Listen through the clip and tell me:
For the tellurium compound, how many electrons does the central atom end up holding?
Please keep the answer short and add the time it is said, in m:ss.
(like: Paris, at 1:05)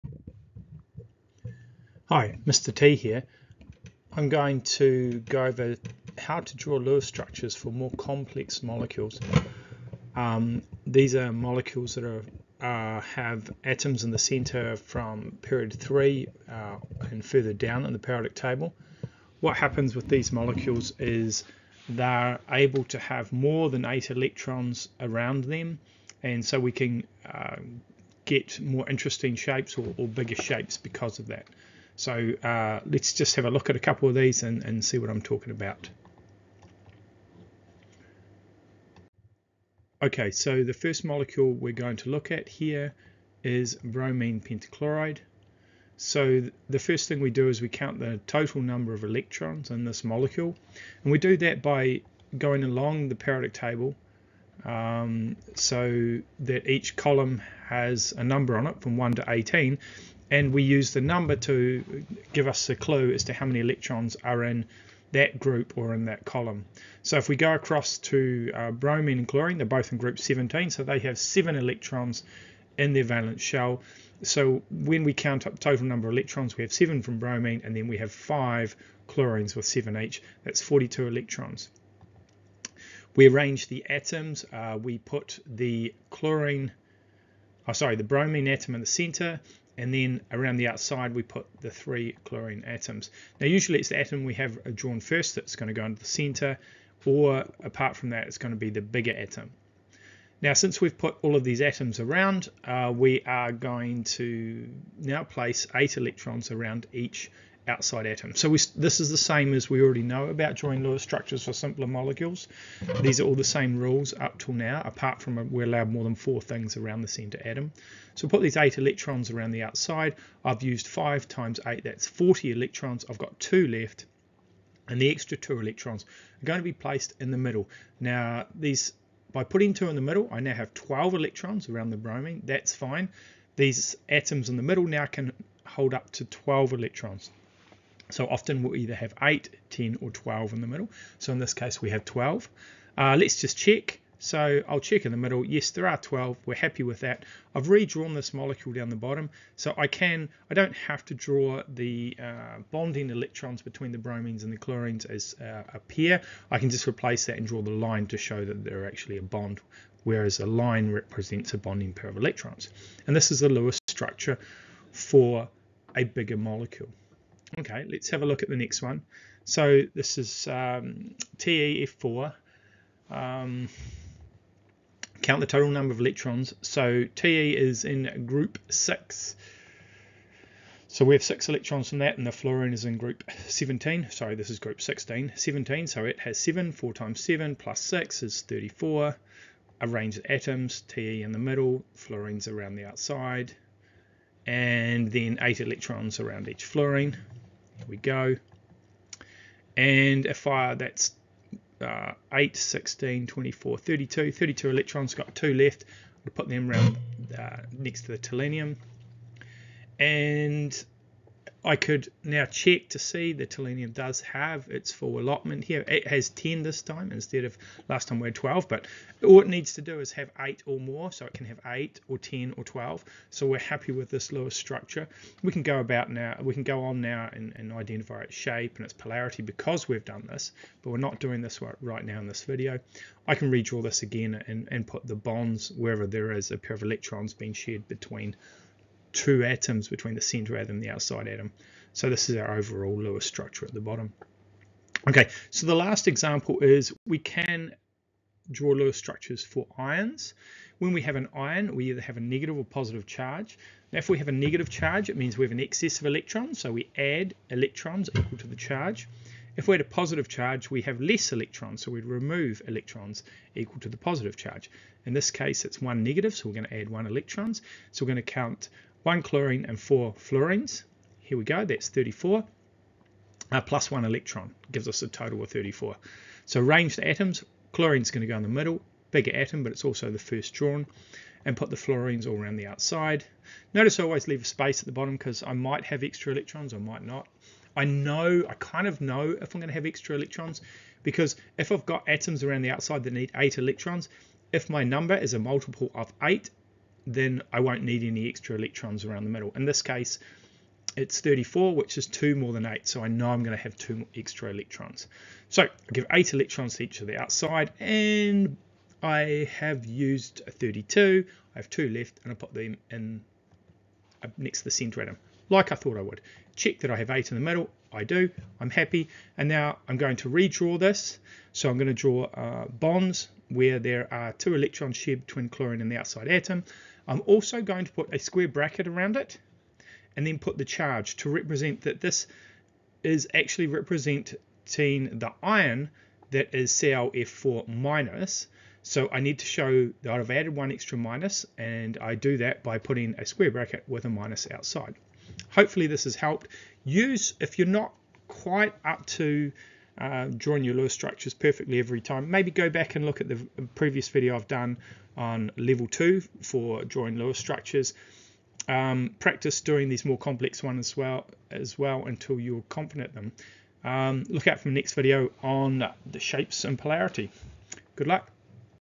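10, at 3:35.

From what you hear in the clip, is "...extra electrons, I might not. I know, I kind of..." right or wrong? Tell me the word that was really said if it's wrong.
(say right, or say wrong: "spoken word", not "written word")
right.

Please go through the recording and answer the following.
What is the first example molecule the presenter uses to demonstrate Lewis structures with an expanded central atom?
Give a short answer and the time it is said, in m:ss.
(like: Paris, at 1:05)
Bromine pentachloride, at 0:43.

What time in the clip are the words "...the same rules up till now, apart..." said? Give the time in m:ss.
1:53.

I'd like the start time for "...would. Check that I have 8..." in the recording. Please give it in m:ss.
5:16.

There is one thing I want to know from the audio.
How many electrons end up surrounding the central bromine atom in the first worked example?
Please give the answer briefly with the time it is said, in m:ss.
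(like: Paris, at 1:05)
12, at 2:10.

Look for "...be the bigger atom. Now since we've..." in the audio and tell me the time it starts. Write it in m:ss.
1:38.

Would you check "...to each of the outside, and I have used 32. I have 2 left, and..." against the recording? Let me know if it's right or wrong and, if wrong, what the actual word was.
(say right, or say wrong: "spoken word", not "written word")
right.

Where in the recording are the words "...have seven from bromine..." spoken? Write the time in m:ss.
1:16.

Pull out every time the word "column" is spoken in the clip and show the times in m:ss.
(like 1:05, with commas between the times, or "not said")
0:56, 1:06.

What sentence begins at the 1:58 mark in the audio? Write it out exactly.
So put these eight electrons around the outside.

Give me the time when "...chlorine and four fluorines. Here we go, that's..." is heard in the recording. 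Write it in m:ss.
4:29.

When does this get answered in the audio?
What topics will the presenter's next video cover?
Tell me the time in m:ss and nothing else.
6:06.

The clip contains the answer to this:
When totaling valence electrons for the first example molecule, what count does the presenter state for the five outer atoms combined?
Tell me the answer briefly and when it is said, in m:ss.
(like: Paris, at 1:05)
42 electrons, at 1:20.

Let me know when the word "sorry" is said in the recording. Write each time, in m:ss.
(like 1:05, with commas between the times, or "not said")
1:27, 3:04.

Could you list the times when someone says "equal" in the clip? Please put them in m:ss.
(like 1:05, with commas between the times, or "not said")
4:18, 4:23.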